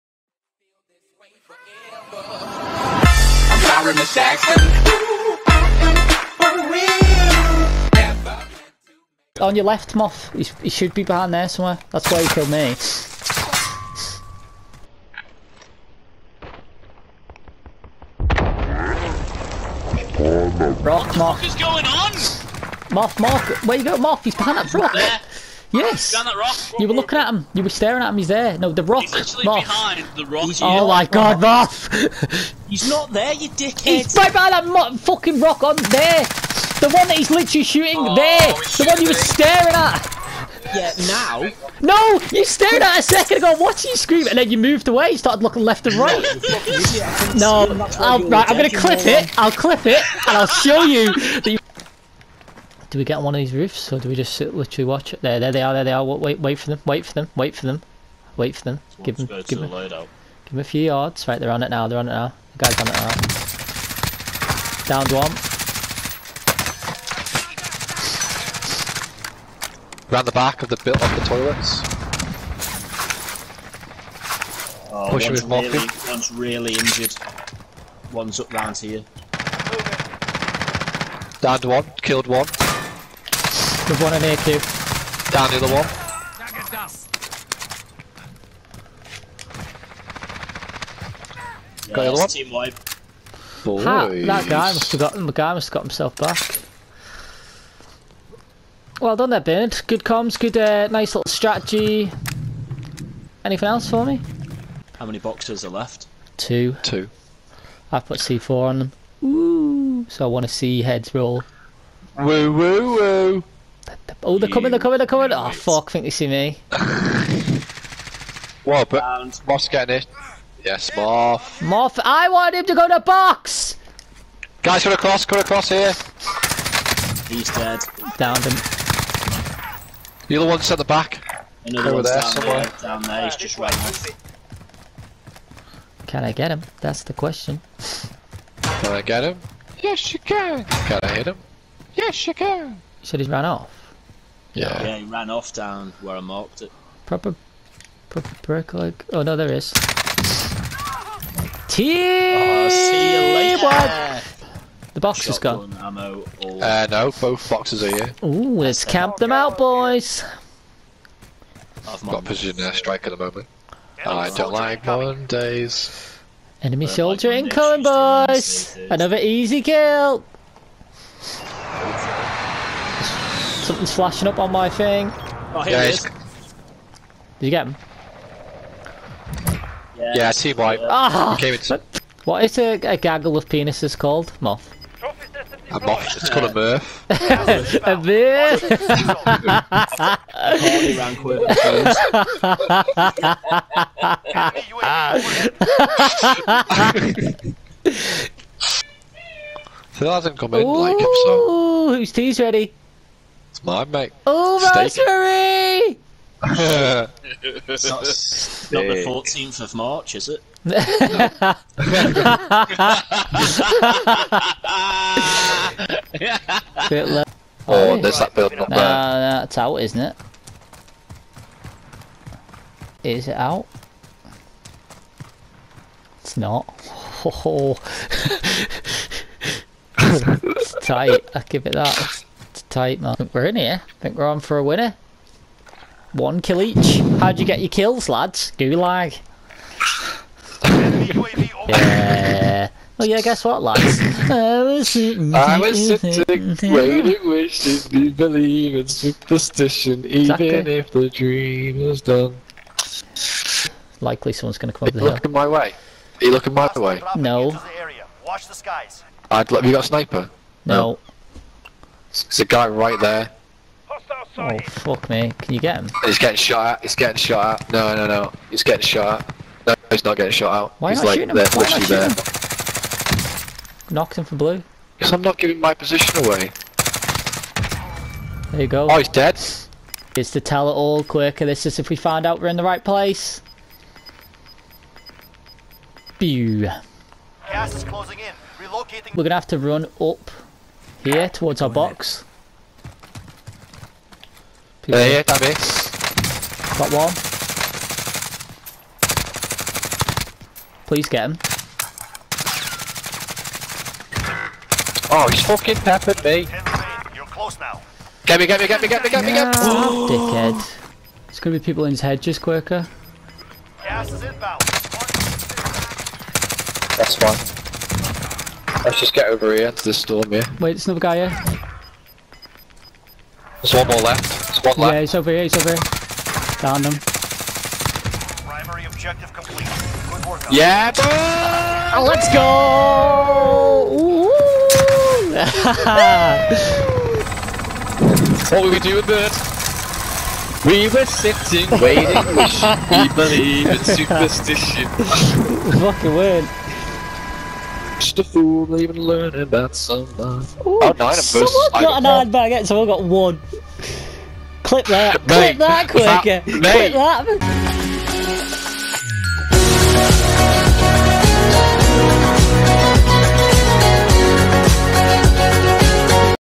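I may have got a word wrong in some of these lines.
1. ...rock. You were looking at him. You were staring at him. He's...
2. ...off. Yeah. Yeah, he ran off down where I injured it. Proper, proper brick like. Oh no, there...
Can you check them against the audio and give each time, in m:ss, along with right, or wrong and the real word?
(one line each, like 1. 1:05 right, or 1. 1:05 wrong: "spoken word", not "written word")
1. 0:26 right
2. 2:23 wrong: "marked", not "injured".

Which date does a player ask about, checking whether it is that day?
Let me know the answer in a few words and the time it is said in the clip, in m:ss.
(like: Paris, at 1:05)
14th of March, at 3:29.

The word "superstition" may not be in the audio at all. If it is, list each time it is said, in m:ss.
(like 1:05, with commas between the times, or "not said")
4:08, 5:43.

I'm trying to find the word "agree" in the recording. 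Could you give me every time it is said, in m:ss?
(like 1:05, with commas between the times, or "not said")
not said.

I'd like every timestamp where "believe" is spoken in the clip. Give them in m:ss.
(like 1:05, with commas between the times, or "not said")
4:08, 5:43.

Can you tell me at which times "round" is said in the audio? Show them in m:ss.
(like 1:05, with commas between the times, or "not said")
1:10, 1:18, 1:59.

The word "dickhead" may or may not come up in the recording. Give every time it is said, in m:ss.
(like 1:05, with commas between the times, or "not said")
0:33, 5:10.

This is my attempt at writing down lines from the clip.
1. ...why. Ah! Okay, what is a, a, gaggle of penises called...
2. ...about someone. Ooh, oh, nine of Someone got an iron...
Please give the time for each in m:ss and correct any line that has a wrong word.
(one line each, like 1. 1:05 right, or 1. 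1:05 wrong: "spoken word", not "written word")
1. 3:00 right
2. 5:49 right.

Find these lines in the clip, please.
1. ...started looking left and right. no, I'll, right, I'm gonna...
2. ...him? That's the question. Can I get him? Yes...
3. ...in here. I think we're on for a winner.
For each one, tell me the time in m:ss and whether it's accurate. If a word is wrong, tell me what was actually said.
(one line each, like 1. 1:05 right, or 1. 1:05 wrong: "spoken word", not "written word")
1. 0:45 right
2. 2:16 right
3. 3:53 right.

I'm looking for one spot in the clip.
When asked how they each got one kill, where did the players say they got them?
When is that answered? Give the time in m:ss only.
3:58.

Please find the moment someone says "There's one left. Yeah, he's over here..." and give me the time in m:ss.
5:24.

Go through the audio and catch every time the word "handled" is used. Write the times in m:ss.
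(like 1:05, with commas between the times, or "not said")
not said.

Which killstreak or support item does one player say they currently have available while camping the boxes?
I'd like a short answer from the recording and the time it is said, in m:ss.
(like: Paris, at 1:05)
Precision air strike, at 2:42.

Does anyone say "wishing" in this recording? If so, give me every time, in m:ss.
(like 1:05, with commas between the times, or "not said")
4:07, 5:42.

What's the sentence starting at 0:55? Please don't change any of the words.
There, there they are, there they are.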